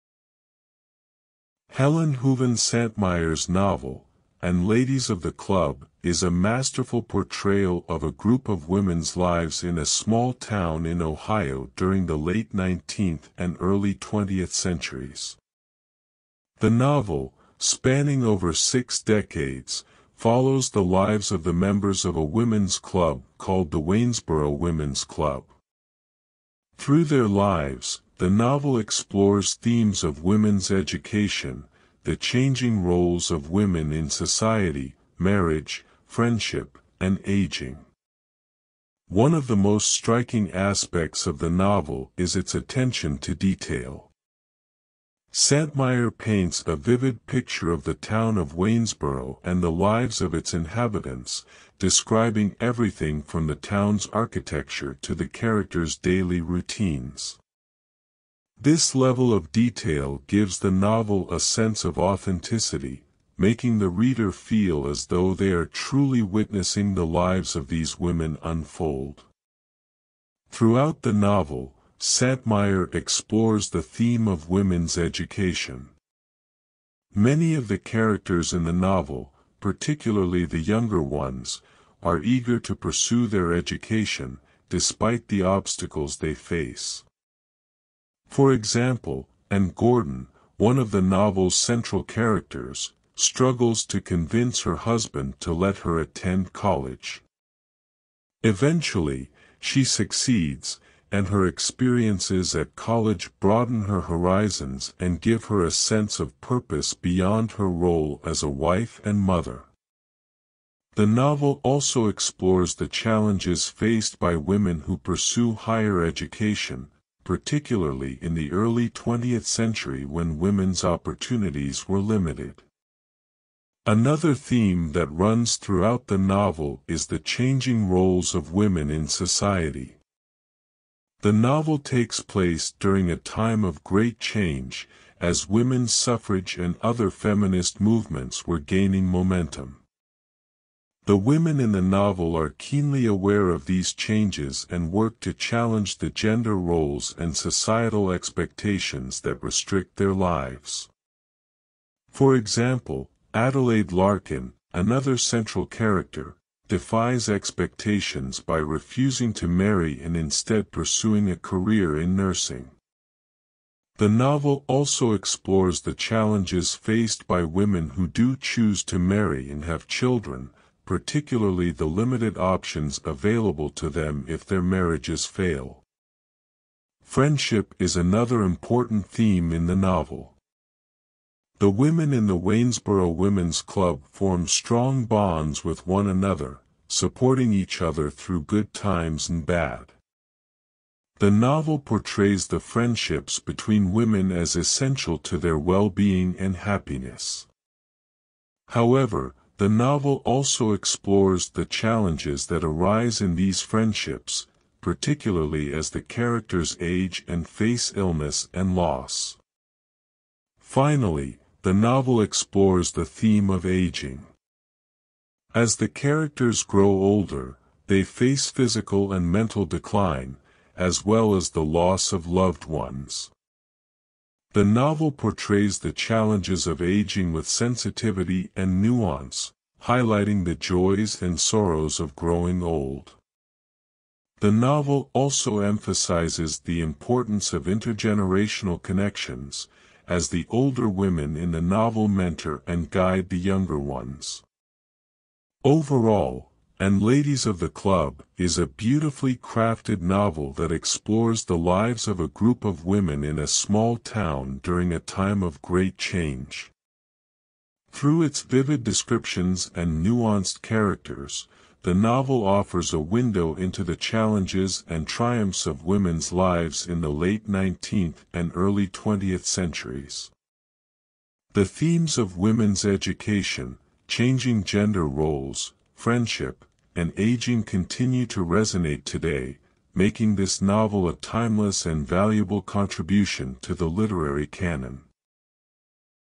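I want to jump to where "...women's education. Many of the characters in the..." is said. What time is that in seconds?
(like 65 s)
74 s.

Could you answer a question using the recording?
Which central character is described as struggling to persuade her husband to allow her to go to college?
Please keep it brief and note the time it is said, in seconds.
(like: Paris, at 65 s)
Anne Gordon, at 89 s.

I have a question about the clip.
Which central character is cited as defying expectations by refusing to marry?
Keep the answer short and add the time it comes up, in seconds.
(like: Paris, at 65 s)
Adelaide Larkin, at 153 s.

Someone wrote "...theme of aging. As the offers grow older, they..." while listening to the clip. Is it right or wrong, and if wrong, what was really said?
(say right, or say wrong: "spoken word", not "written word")
wrong: "characters", not "offers".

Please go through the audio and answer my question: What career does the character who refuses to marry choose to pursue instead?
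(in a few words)
Nursing.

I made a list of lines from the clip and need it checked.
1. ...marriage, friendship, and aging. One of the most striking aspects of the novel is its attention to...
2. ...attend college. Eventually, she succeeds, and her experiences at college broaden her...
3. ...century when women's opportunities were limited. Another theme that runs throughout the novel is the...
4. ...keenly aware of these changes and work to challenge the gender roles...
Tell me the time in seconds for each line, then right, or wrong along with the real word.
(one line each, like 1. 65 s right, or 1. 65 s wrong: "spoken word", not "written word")
1. 35 s right
2. 95 s right
3. 119 s right
4. 142 s right.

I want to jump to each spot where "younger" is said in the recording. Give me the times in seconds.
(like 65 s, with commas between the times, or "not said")
80 s, 243 s.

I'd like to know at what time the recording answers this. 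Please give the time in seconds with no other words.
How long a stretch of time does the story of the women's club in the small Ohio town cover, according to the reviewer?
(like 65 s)
18 s.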